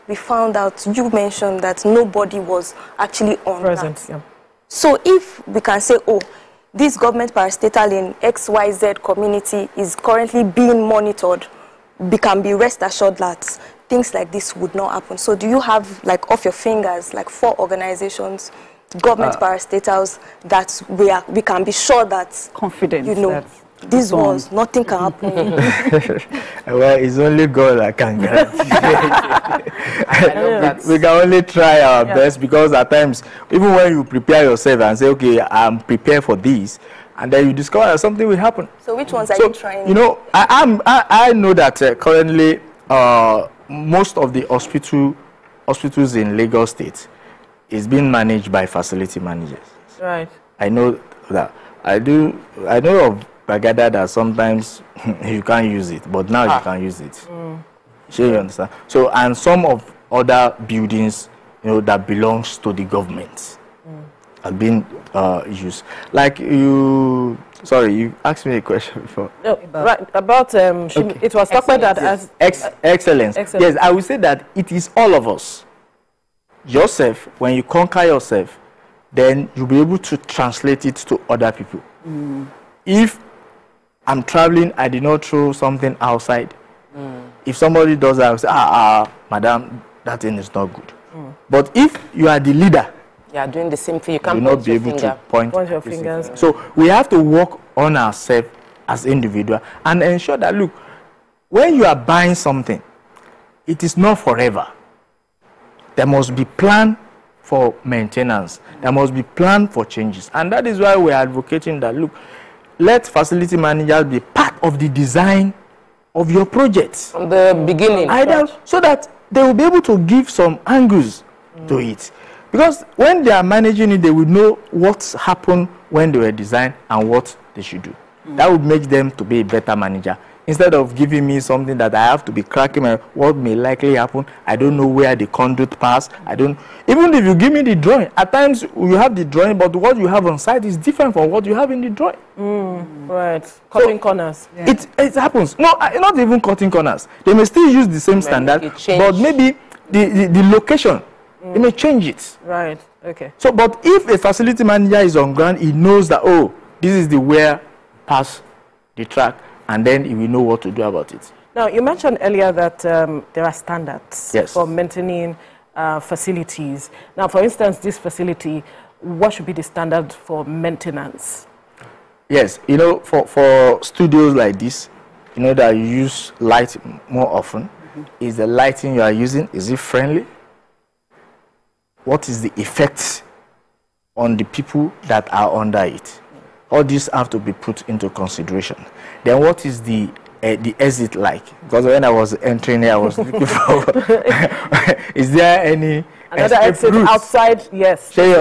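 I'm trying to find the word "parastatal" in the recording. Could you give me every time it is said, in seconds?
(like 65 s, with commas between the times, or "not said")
7 s, 19 s.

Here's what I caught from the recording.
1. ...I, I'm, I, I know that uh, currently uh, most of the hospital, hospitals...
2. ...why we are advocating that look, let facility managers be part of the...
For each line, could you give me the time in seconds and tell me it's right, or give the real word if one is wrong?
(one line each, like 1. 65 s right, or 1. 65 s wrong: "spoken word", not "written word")
1. 40 s right
2. 110 s right.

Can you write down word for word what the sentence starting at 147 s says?
They may still use the same maybe standard, but maybe the, the, the location mm.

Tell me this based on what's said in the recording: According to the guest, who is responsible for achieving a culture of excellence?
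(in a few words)
All of us.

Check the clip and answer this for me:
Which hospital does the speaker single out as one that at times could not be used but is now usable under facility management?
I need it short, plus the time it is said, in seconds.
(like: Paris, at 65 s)
Gbagada, at 53 s.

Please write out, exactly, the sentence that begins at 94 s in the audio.
You can't you not be able finger.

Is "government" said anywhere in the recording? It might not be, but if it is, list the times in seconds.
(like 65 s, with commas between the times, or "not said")
6 s, 19 s, 62 s.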